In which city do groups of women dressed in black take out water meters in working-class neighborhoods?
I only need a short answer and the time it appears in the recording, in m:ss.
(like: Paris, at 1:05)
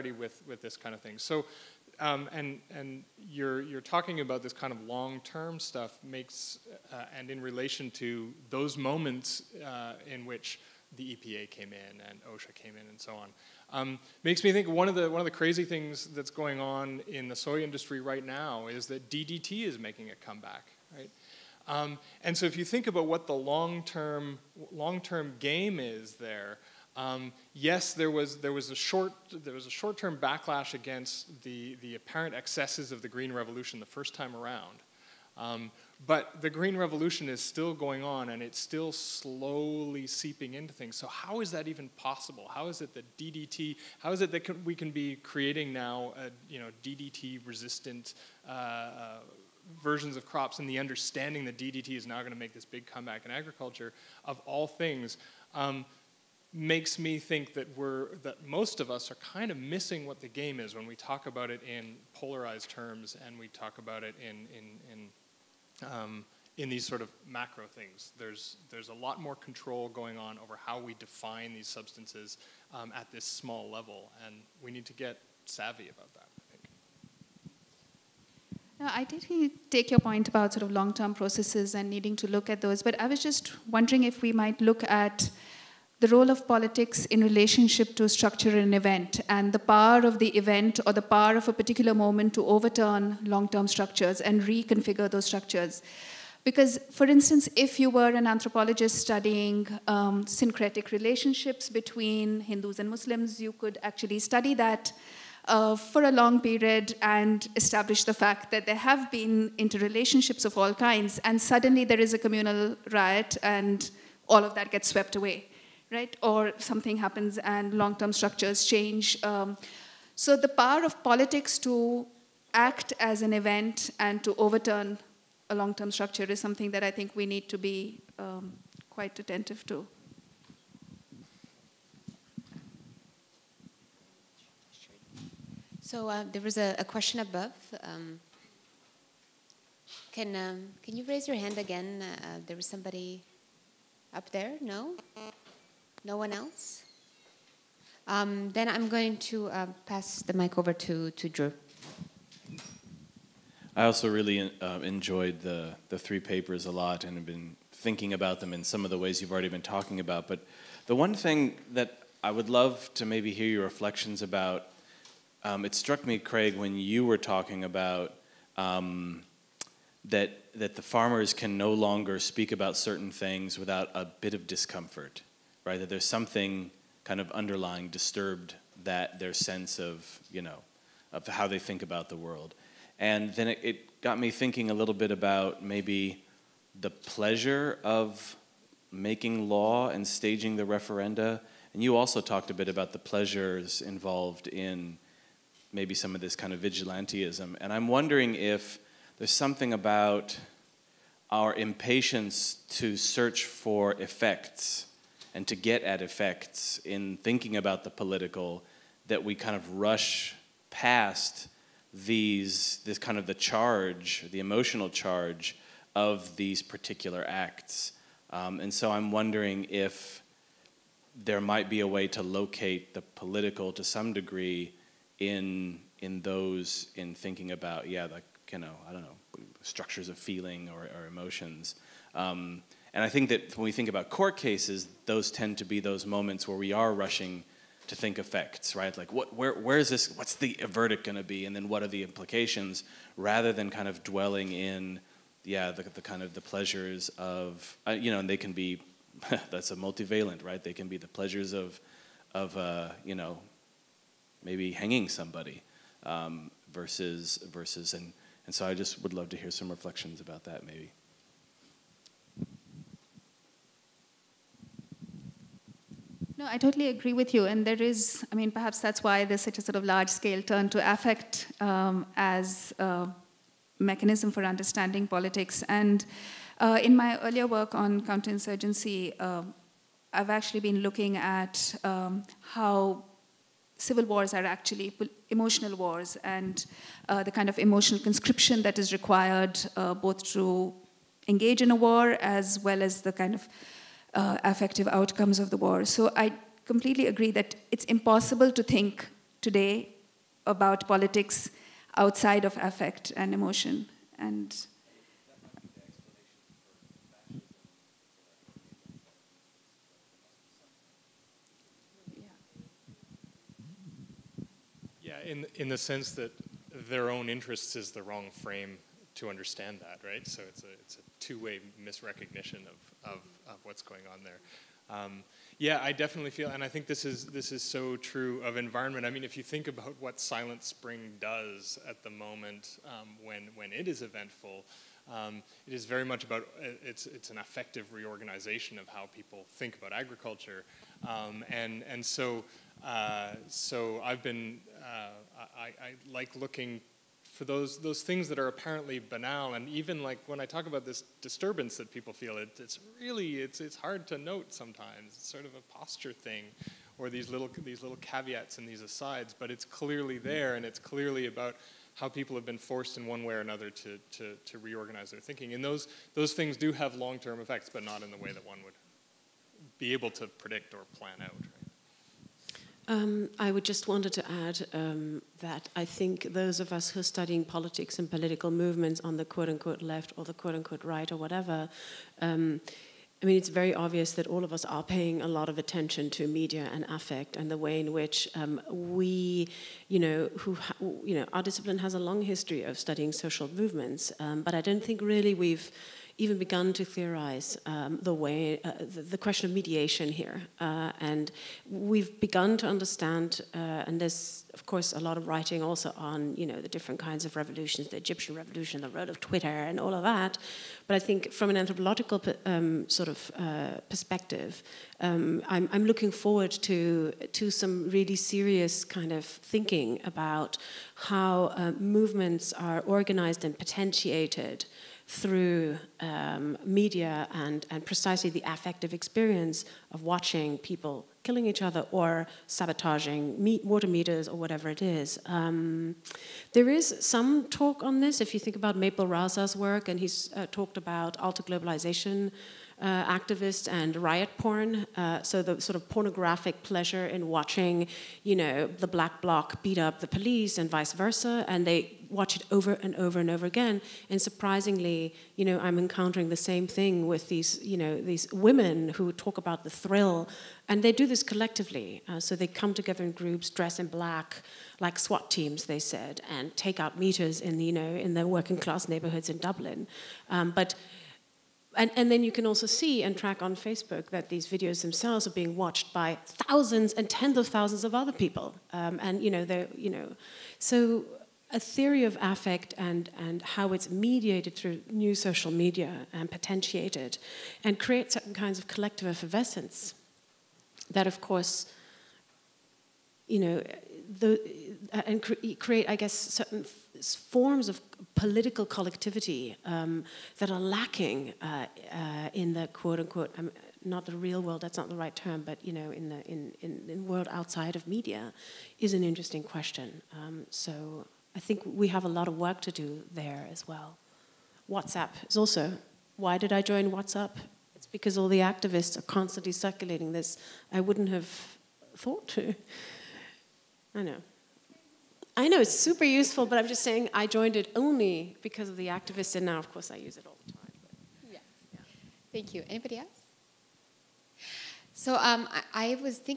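Dublin, at 7:49.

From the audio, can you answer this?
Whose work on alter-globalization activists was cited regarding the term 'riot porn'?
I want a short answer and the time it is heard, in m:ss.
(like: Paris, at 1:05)
Maple Razsa, at 7:18.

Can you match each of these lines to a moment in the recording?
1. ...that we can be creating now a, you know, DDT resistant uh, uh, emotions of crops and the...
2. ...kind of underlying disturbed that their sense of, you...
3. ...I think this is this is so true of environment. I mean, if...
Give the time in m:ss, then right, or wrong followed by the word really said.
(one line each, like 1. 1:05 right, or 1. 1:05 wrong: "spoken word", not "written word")
1. 0:44 wrong: "versions", not "emotions"
2. 2:57 right
3. 5:26 right.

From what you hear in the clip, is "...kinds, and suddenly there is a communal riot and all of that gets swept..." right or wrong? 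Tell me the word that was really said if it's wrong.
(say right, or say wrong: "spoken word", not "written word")
right.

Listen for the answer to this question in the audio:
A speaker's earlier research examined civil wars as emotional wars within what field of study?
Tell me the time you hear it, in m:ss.
4:38.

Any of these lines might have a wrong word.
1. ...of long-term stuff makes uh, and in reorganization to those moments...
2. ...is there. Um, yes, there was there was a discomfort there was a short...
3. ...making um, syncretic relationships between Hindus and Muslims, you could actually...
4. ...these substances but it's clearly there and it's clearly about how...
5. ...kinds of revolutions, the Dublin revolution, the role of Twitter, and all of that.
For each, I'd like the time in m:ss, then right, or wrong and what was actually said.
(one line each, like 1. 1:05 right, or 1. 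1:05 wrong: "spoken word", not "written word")
1. 0:04 wrong: "relation", not "reorganization"
2. 0:25 wrong: "short", not "discomfort"
3. 1:38 wrong: "studying", not "making"
4. 5:58 wrong: "asides", not "substances"
5. 6:47 wrong: "Egyptian", not "Dublin".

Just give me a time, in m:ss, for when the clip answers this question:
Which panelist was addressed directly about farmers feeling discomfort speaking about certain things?
2:46.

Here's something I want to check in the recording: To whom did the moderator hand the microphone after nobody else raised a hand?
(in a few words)
Drew.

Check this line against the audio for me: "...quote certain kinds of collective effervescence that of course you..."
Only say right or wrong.
wrong.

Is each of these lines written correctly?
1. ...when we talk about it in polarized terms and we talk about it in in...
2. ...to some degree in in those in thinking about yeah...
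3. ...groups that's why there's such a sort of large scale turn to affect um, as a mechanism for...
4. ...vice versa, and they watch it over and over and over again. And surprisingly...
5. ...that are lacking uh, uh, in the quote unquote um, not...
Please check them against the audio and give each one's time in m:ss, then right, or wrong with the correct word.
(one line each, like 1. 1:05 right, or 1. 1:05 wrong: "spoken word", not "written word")
1. 1:00 right
2. 3:43 right
3. 4:28 wrong: "perhaps", not "groups"
4. 7:30 right
5. 8:20 right.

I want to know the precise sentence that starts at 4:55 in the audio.
So I completely agree that it's impossible to think today about politics outside of affect and emotion.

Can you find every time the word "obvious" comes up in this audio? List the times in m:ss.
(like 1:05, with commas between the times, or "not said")
6:23.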